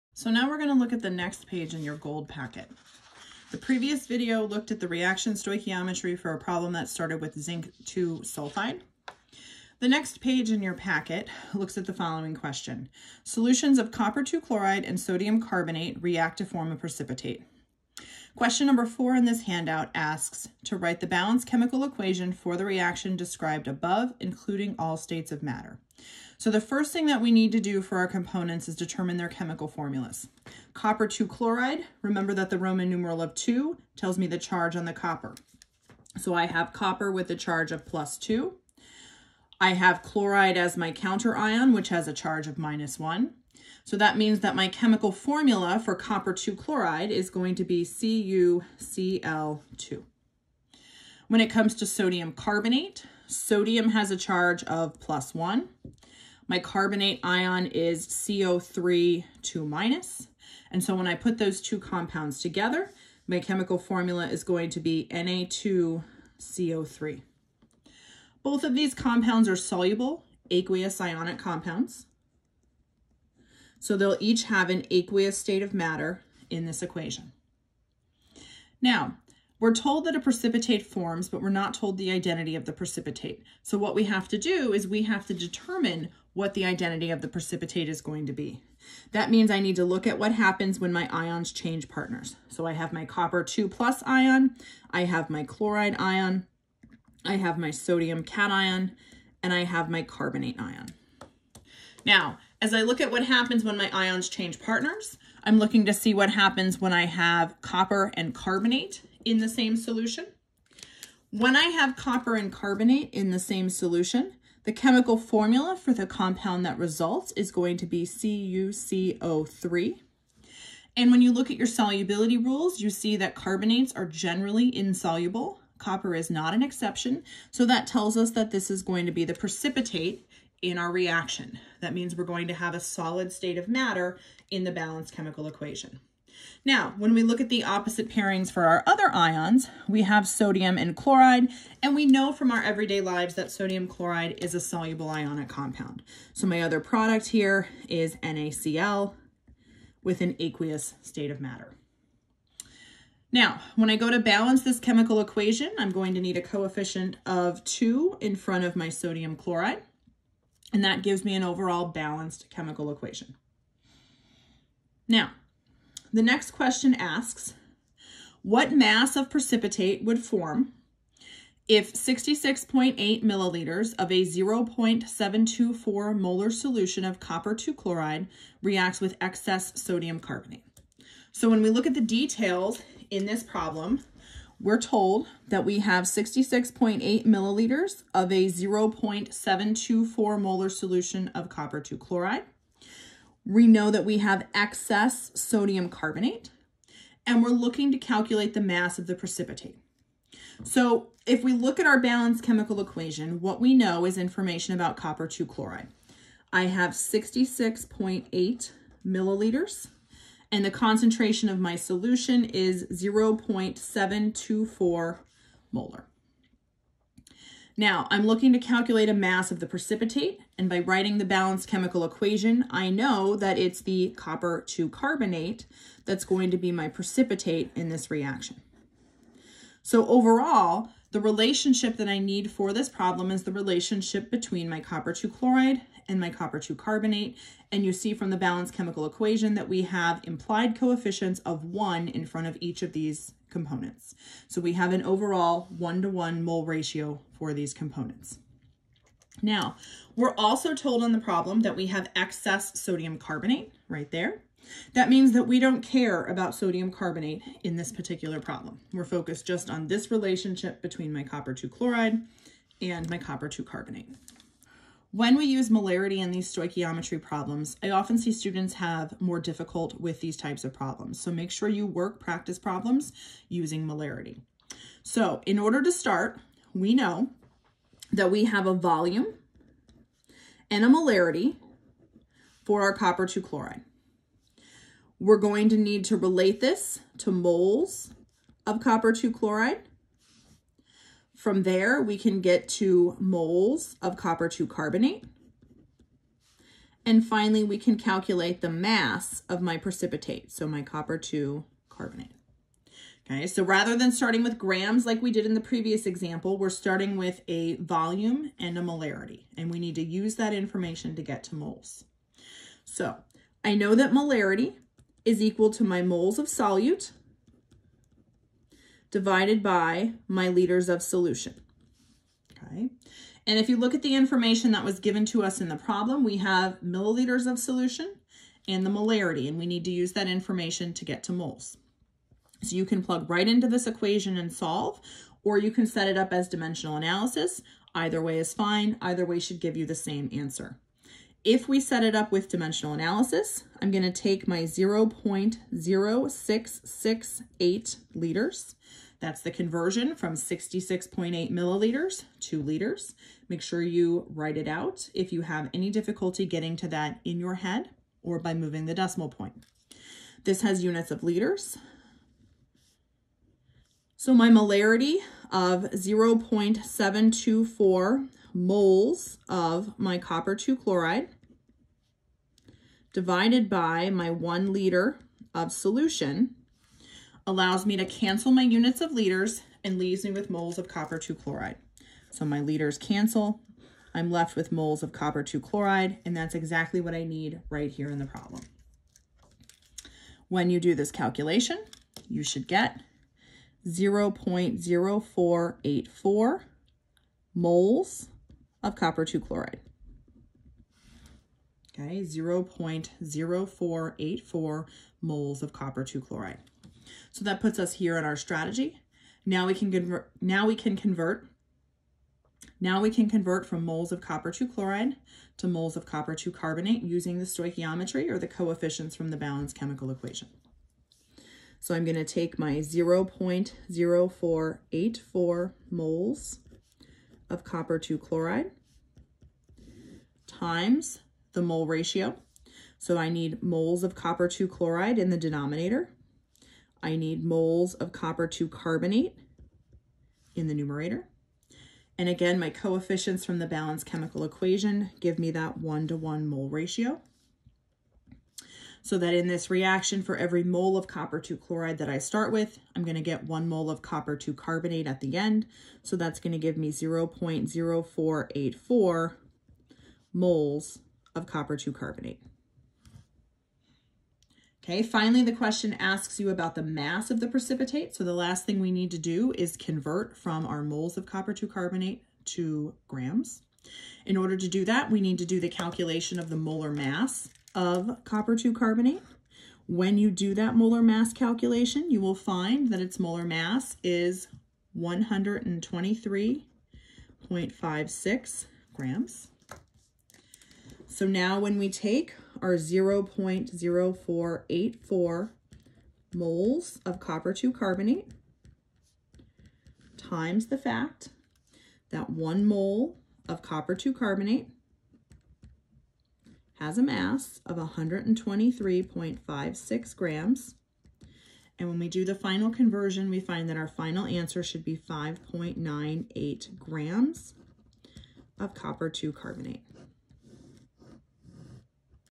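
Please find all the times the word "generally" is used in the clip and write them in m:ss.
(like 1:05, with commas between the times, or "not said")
2:04.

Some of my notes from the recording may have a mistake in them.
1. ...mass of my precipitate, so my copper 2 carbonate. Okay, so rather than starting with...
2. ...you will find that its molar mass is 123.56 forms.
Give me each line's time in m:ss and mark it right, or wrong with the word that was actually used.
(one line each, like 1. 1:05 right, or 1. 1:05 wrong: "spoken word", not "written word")
1. 4:58 right
2. 8:02 wrong: "grams", not "forms".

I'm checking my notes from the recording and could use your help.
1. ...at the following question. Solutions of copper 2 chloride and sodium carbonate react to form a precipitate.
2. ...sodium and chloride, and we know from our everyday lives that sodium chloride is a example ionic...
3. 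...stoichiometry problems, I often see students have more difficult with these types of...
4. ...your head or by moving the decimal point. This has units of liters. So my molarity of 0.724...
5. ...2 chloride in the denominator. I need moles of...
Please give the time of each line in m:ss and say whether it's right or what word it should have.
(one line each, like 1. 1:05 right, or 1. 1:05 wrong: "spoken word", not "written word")
1. 0:11 right
2. 2:20 wrong: "soluble", not "example"
3. 4:26 right
4. 5:57 right
5. 7:14 right.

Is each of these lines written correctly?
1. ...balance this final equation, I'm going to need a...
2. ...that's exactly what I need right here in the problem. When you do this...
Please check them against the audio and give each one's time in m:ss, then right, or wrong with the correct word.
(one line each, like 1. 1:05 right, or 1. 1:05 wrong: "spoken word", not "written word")
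1. 2:34 wrong: "chemical", not "final"
2. 6:26 right.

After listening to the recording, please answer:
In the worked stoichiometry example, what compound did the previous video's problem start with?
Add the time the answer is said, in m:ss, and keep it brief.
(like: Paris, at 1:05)
Zinc 2 sulfide, at 0:07.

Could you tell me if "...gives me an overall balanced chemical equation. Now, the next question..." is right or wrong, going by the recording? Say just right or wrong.
right.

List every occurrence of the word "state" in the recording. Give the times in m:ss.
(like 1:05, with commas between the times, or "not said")
0:24, 1:15, 2:13, 2:31.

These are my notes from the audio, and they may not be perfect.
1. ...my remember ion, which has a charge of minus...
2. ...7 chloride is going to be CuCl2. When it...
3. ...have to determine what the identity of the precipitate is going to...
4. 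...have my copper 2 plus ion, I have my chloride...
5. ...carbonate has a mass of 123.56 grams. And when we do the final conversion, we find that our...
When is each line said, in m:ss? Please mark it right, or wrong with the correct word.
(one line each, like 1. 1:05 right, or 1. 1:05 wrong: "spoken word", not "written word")
1. 0:40 wrong: "counter", not "remember"
2. 0:46 wrong: "2", not "7"
3. 1:25 right
4. 1:32 right
5. 8:24 right.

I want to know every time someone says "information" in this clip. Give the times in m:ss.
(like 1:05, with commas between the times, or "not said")
3:24, 5:10, 5:24, 5:30.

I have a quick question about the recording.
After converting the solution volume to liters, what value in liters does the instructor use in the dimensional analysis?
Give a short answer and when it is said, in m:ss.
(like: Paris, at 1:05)
0.0668, at 5:44.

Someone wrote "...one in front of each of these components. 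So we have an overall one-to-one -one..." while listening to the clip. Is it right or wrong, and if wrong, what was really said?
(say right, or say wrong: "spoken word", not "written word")
right.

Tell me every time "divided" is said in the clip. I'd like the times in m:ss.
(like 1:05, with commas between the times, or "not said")
5:19, 6:13.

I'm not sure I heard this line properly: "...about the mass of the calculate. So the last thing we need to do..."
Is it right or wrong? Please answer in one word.
wrong.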